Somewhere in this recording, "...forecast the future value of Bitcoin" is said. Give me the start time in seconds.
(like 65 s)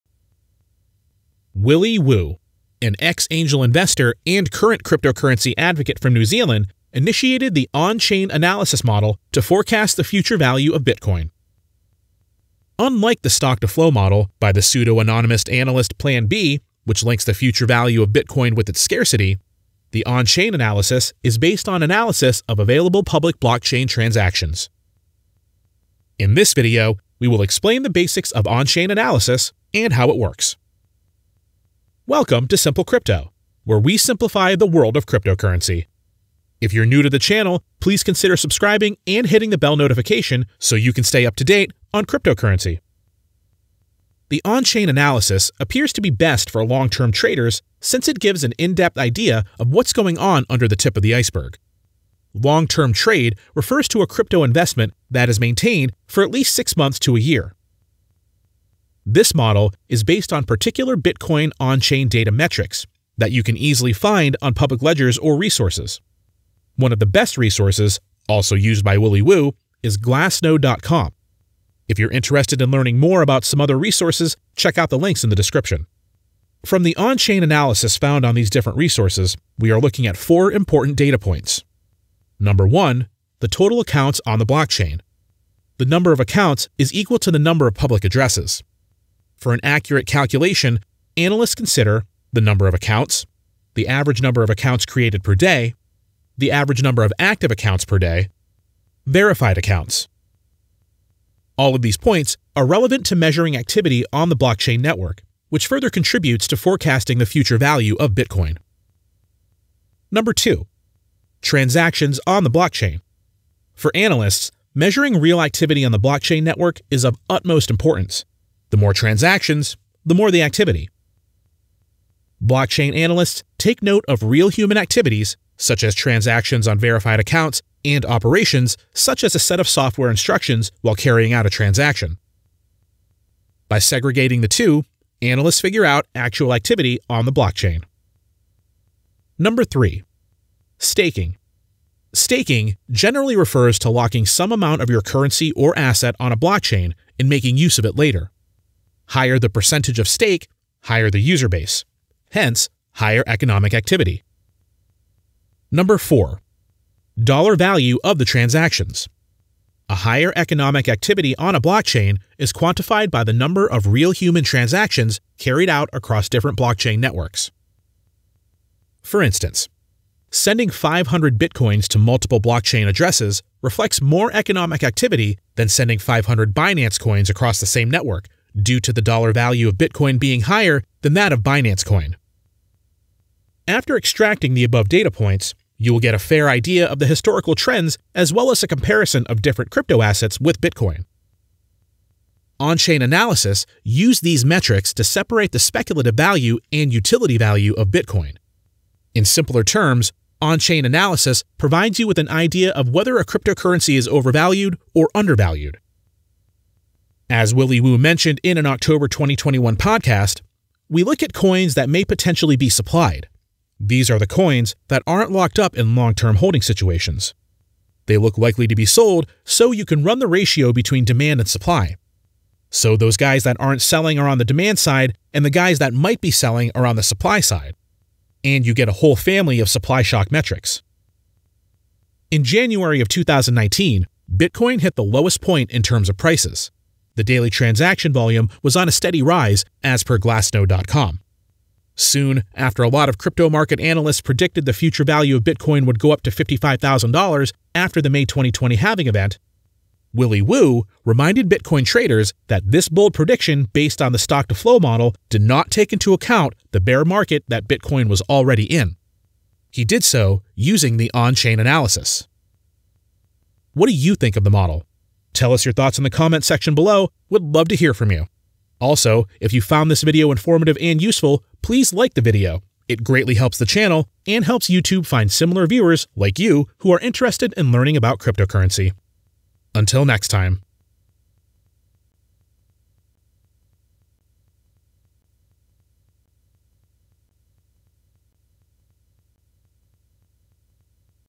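9 s.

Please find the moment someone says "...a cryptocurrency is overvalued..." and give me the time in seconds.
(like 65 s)
203 s.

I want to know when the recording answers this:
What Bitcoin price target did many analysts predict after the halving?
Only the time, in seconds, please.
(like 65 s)
246 s.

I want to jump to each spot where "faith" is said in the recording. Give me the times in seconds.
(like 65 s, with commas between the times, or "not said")
not said.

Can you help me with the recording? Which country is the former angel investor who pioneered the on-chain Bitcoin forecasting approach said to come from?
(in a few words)
New Zealand.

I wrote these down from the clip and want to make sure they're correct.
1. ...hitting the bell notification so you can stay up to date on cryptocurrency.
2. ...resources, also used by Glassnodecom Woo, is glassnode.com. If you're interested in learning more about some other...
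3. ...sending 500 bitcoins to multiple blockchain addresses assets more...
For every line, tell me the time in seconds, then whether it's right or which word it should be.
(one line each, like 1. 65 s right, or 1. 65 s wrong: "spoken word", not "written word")
1. 39 s right
2. 67 s wrong: "Willy", not "Glassnodecom"
3. 170 s wrong: "reflects", not "assets".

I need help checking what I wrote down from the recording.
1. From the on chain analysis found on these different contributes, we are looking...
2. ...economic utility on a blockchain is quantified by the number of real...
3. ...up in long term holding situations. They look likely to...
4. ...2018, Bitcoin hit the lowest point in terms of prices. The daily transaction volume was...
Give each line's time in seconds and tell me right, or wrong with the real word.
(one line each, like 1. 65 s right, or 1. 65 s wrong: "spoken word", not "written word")
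1. 76 s wrong: "resources", not "contributes"
2. 160 s wrong: "activity", not "utility"
3. 215 s right
4. 233 s wrong: "2019", not "2018".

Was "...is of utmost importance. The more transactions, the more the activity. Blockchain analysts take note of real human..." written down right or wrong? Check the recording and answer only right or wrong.
right.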